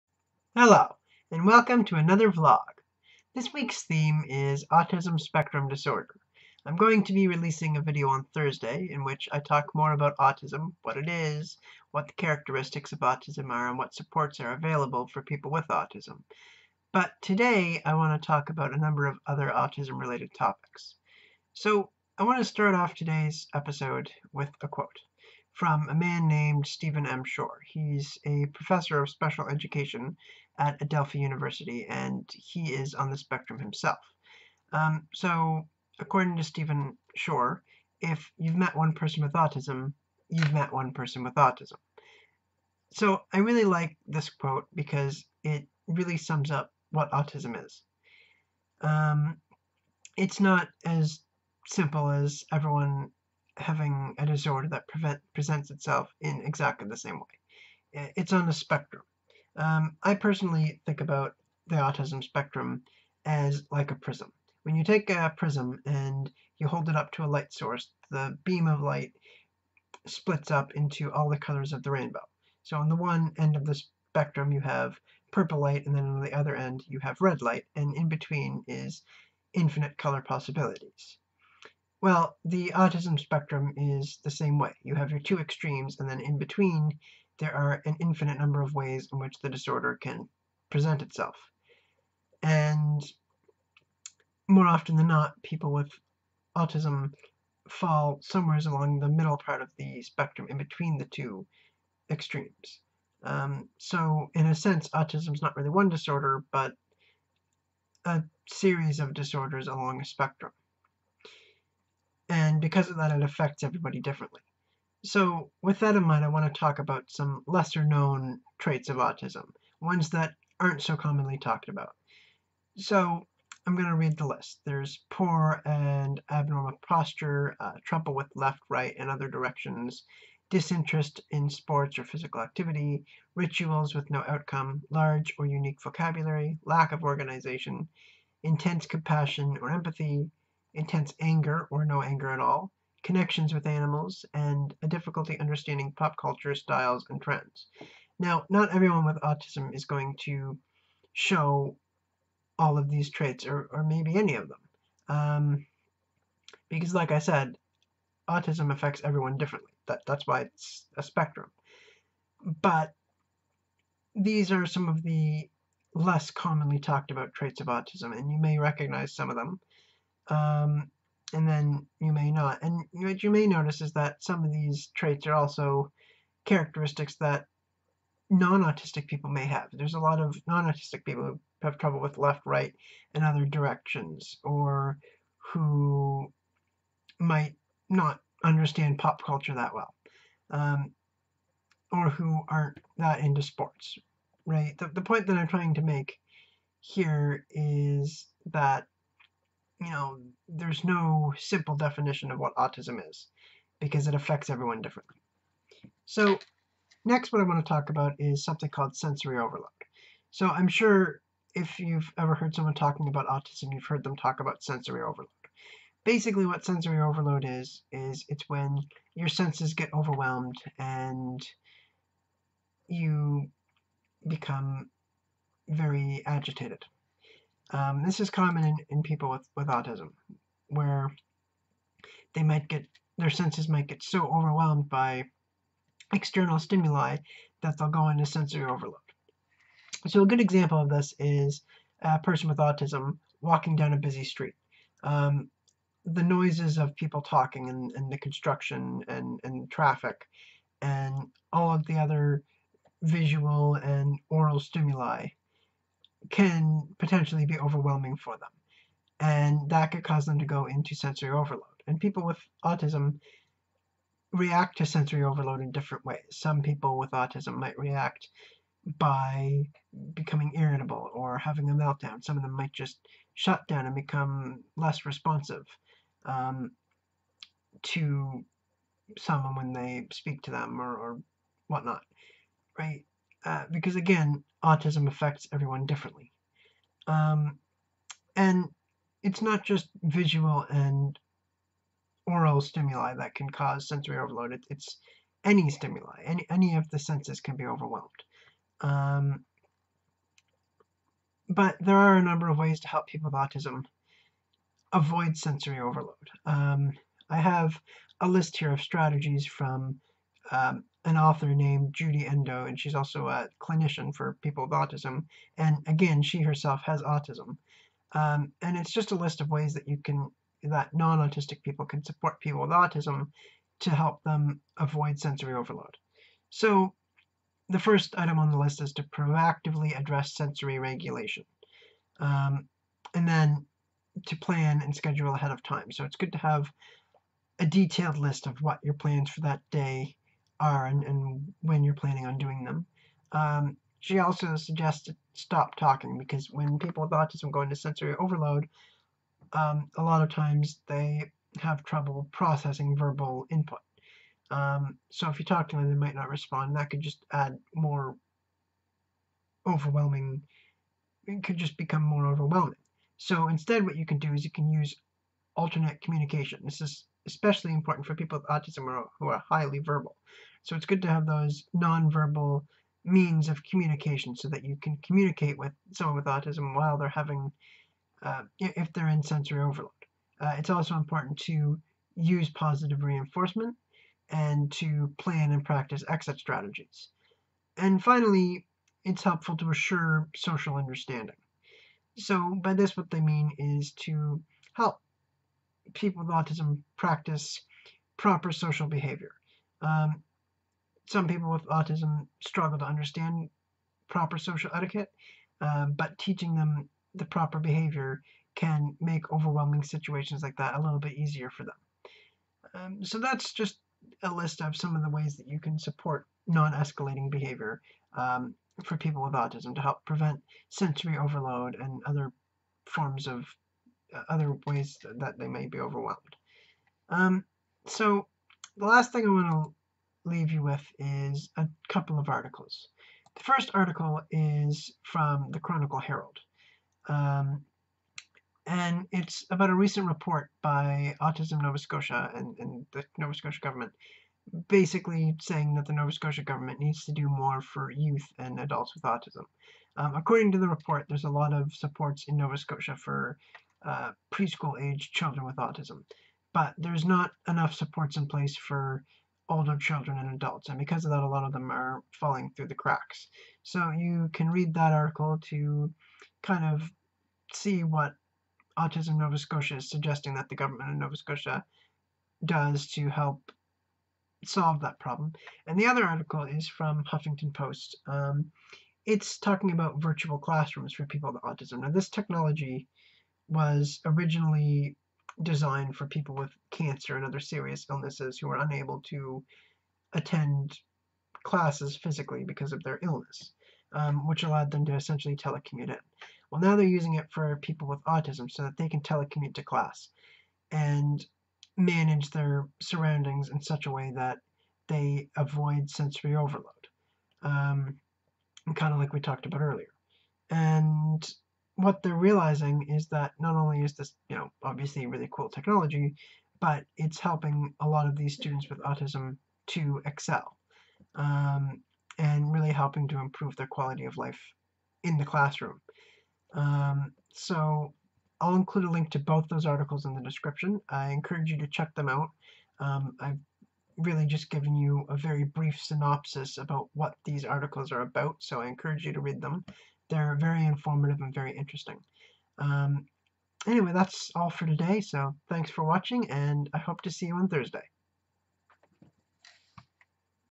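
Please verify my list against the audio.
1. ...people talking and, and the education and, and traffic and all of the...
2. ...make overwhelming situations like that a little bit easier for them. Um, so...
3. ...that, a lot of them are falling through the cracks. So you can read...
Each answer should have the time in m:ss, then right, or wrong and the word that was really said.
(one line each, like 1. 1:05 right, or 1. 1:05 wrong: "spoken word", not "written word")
1. 4:06 wrong: "construction", not "education"
2. 6:49 right
3. 7:41 right.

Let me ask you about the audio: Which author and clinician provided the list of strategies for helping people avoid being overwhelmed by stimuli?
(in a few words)
Judy Endow.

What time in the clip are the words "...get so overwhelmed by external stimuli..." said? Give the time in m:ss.
3:53.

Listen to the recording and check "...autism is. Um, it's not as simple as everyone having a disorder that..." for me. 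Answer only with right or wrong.
right.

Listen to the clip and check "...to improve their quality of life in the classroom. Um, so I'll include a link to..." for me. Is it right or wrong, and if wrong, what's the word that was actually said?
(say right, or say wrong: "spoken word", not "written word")
right.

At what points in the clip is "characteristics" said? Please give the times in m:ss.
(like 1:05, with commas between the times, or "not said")
0:12, 2:56.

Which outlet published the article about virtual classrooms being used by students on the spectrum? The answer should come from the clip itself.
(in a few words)
Huffington Post.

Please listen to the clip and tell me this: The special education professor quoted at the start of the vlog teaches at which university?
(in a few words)
Adelphi University.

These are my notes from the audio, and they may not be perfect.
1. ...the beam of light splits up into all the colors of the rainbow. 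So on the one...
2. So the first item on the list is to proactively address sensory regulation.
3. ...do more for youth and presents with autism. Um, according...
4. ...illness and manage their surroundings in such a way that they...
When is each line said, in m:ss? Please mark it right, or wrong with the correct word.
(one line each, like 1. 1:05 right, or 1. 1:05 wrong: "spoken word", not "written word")
1. 1:08 right
2. 5:26 right
3. 7:27 wrong: "adults", not "presents"
4. 8:19 wrong: "class", not "illness".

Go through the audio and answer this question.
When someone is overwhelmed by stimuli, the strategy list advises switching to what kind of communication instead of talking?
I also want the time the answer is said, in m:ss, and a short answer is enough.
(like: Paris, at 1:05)
Alternate communication, at 6:05.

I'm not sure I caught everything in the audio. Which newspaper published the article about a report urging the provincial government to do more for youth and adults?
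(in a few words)
The Chronicle Herald.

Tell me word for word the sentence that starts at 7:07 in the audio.
Um, so the last thing I want to leave you with is a couple of articles.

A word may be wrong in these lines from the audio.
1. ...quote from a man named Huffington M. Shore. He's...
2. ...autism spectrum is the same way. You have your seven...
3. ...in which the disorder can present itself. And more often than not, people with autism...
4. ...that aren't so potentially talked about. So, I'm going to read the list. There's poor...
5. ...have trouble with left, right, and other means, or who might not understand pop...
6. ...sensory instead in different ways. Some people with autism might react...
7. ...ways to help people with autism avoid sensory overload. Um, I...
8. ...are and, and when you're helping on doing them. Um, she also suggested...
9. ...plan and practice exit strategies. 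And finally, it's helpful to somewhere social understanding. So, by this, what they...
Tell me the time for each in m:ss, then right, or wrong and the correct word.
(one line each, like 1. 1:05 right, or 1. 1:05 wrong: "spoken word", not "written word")
1. 0:24 wrong: "Stephen", not "Huffington"
2. 1:22 wrong: "two", not "seven"
3. 1:29 right
4. 2:00 wrong: "commonly", not "potentially"
5. 3:01 wrong: "directions", not "means"
6. 4:24 wrong: "overload", not "instead"
7. 5:02 right
8. 5:40 wrong: "planning", not "helping"
9. 6:25 wrong: "assure", not "somewhere".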